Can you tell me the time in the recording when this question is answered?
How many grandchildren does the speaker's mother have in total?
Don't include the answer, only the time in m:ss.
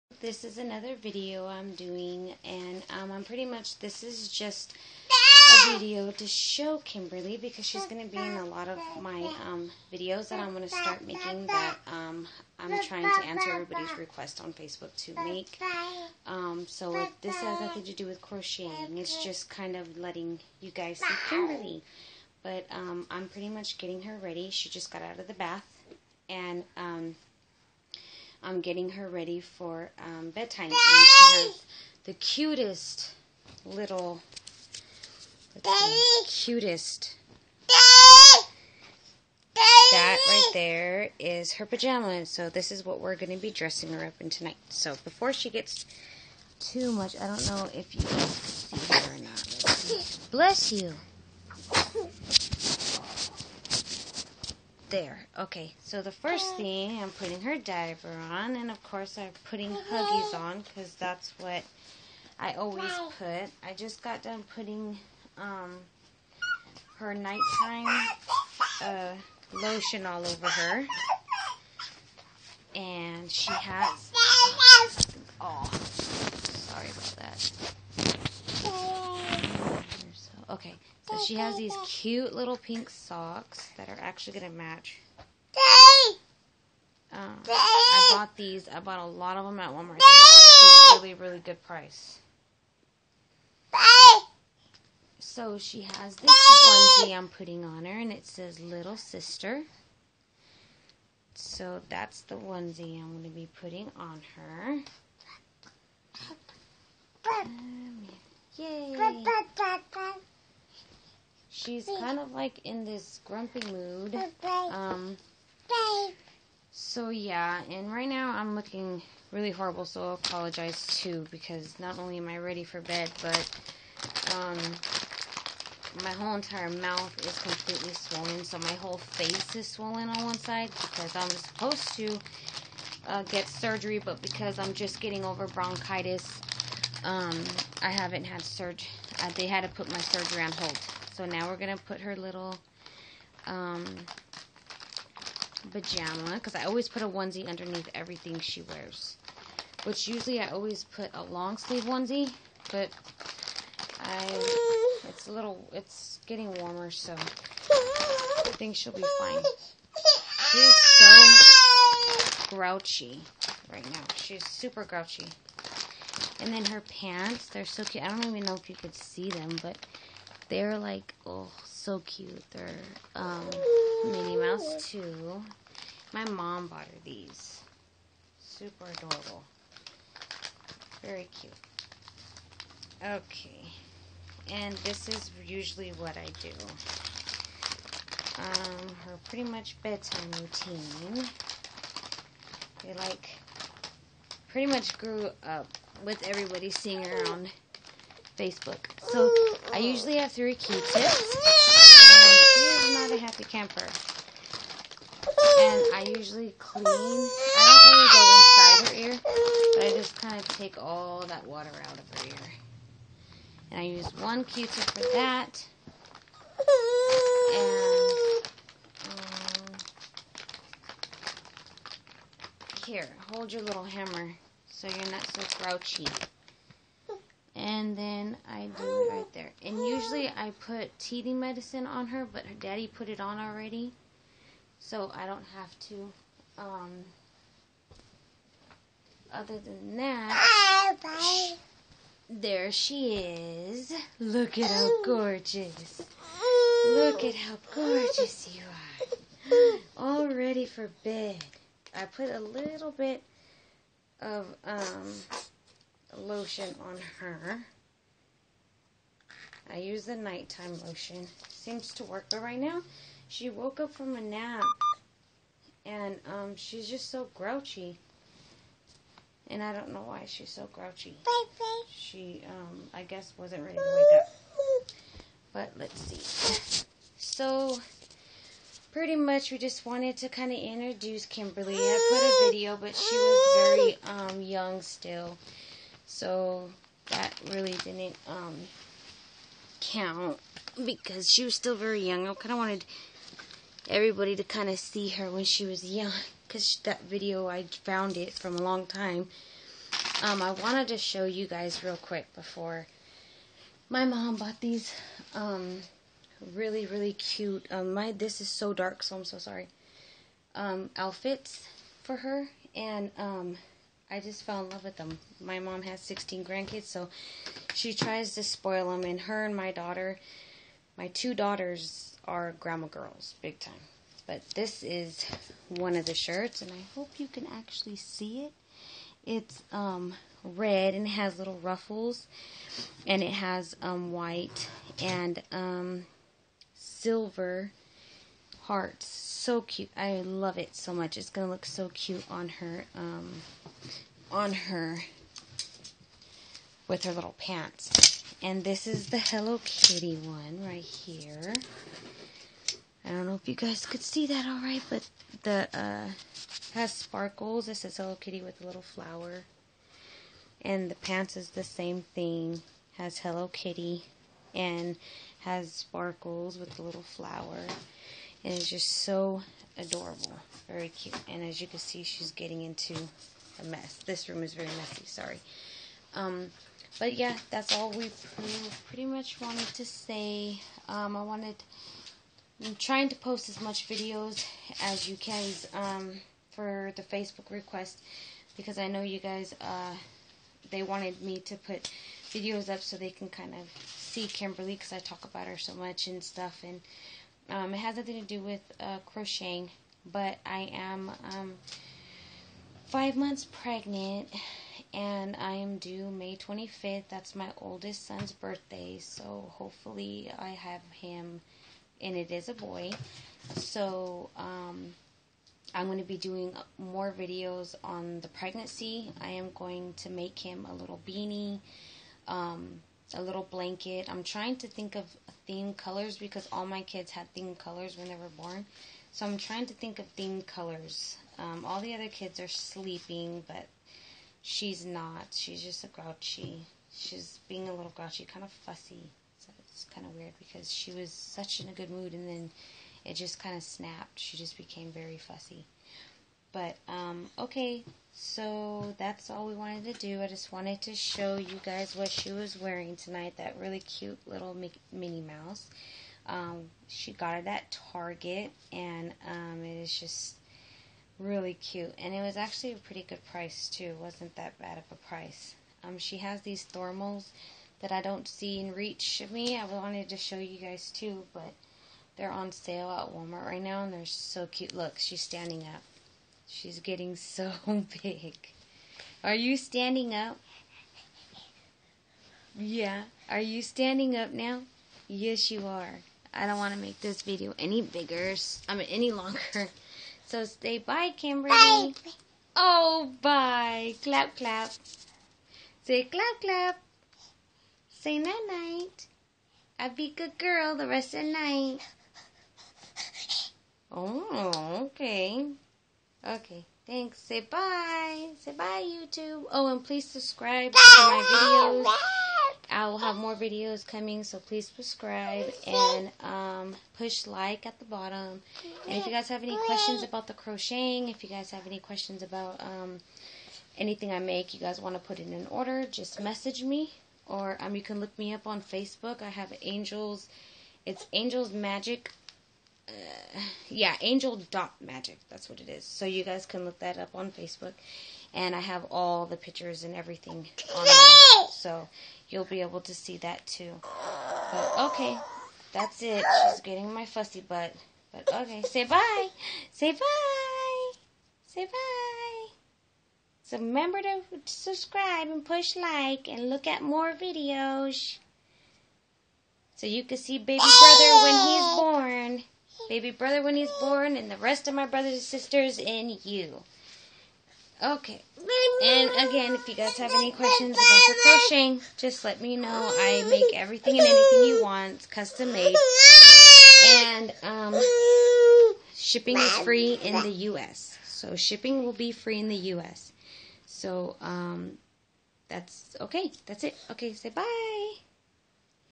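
5:16.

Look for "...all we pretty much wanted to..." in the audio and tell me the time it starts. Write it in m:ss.
6:17.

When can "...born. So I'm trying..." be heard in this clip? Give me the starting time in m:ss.
7:08.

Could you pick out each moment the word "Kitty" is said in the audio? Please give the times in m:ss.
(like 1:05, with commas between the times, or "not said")
5:49, 5:58, 6:03.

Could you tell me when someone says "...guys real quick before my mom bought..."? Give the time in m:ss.
5:01.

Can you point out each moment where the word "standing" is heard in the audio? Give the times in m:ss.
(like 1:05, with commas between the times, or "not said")
7:55, 7:59, 8:03.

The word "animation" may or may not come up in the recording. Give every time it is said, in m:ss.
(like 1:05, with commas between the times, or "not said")
not said.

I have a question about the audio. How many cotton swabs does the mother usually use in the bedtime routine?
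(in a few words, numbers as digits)
3.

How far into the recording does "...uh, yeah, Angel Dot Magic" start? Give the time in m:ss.
8:53.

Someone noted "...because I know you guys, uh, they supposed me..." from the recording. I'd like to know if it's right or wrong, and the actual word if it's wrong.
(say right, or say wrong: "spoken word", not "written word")
wrong: "wanted", not "supposed".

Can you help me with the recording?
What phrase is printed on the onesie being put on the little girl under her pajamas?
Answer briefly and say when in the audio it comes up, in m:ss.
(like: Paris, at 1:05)
Little Sister, at 1:38.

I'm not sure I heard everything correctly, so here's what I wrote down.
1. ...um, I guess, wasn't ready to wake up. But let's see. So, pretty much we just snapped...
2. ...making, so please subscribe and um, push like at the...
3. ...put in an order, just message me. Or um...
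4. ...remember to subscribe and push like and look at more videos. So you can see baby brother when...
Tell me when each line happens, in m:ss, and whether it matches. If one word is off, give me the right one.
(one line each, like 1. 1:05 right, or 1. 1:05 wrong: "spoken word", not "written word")
1. 4:32 wrong: "wanted", not "snapped"
2. 8:33 wrong: "coming", not "making"
3. 8:45 right
4. 9:13 right.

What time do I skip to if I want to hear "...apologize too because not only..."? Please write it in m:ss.
2:00.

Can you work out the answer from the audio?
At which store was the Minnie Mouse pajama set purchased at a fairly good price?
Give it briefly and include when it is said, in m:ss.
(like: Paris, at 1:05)
Target, at 7:37.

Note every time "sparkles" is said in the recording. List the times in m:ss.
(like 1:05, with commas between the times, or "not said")
5:56, 6:05.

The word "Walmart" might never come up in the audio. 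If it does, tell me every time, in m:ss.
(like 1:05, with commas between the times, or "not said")
1:29, 7:53.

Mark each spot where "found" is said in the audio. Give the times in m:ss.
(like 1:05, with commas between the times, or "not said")
4:57.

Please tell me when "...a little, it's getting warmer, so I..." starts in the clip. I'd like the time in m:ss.
2:35.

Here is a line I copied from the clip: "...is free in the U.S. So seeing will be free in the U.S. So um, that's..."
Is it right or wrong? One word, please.
wrong.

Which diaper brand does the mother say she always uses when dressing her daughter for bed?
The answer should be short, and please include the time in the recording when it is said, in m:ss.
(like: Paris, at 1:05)
Huggies, at 1:00.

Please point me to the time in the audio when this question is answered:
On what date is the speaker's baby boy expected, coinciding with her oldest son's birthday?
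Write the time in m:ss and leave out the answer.
6:46.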